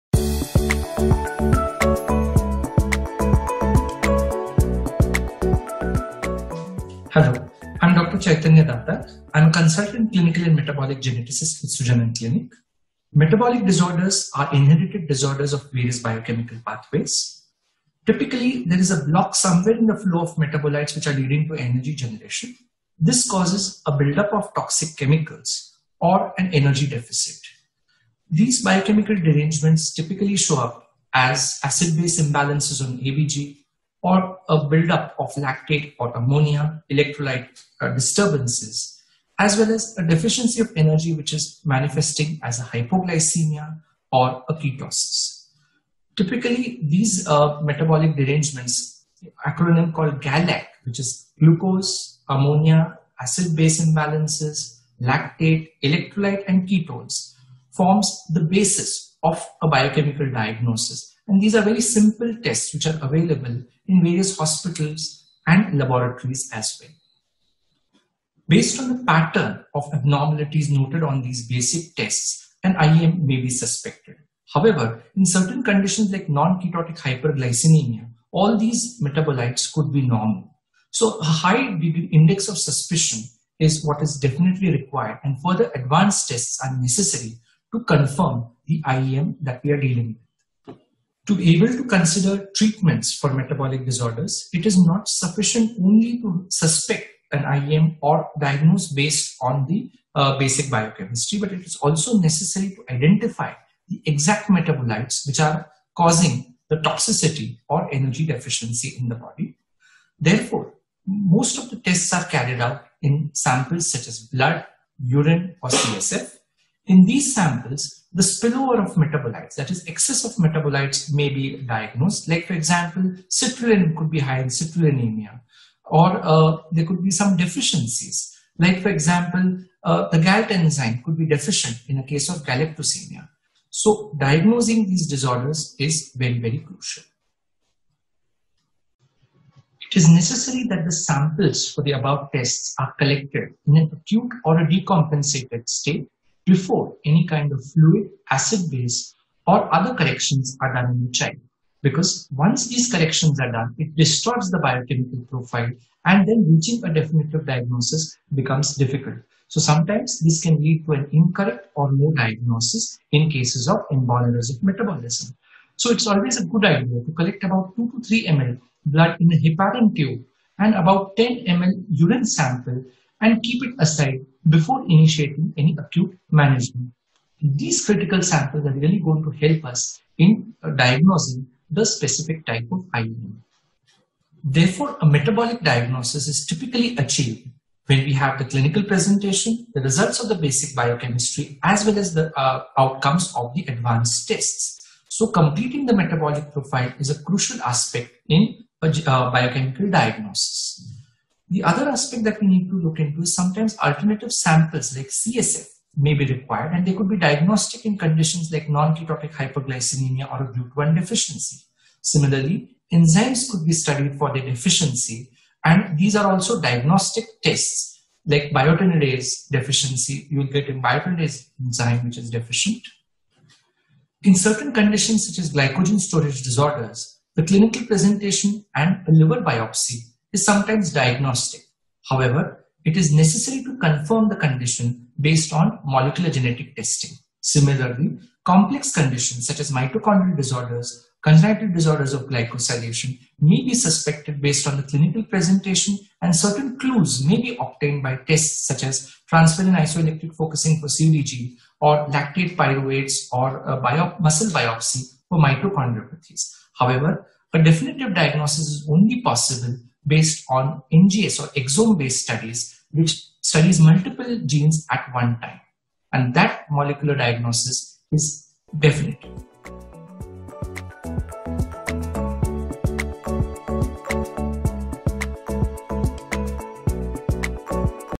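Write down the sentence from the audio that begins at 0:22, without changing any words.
This causes a buildup of toxic chemicals or an energy deficit.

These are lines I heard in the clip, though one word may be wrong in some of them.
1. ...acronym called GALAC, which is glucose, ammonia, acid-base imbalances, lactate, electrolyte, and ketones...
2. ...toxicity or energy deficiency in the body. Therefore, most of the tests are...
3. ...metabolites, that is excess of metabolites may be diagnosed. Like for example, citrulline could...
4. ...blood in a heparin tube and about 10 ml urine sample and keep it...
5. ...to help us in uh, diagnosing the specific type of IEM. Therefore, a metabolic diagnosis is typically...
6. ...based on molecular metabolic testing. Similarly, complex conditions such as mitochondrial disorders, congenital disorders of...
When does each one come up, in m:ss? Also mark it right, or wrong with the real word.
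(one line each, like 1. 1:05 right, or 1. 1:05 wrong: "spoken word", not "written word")
1. 0:49 right
2. 1:46 right
3. 1:58 right
4. 2:48 right
5. 2:59 right
6. 3:55 wrong: "genetic", not "metabolic".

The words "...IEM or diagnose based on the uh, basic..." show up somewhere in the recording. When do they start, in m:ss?
1:37.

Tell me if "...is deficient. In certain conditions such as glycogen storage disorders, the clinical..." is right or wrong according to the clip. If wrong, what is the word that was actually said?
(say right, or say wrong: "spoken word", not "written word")
right.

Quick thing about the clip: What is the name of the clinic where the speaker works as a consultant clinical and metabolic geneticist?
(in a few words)
Sujanan Clinic.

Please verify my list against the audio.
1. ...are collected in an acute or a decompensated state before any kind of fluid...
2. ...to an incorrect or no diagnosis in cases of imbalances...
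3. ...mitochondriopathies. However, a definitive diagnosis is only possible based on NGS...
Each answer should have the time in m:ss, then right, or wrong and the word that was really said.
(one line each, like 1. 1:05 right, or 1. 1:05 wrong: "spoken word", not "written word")
1. 2:22 right
2. 2:40 right
3. 4:15 right.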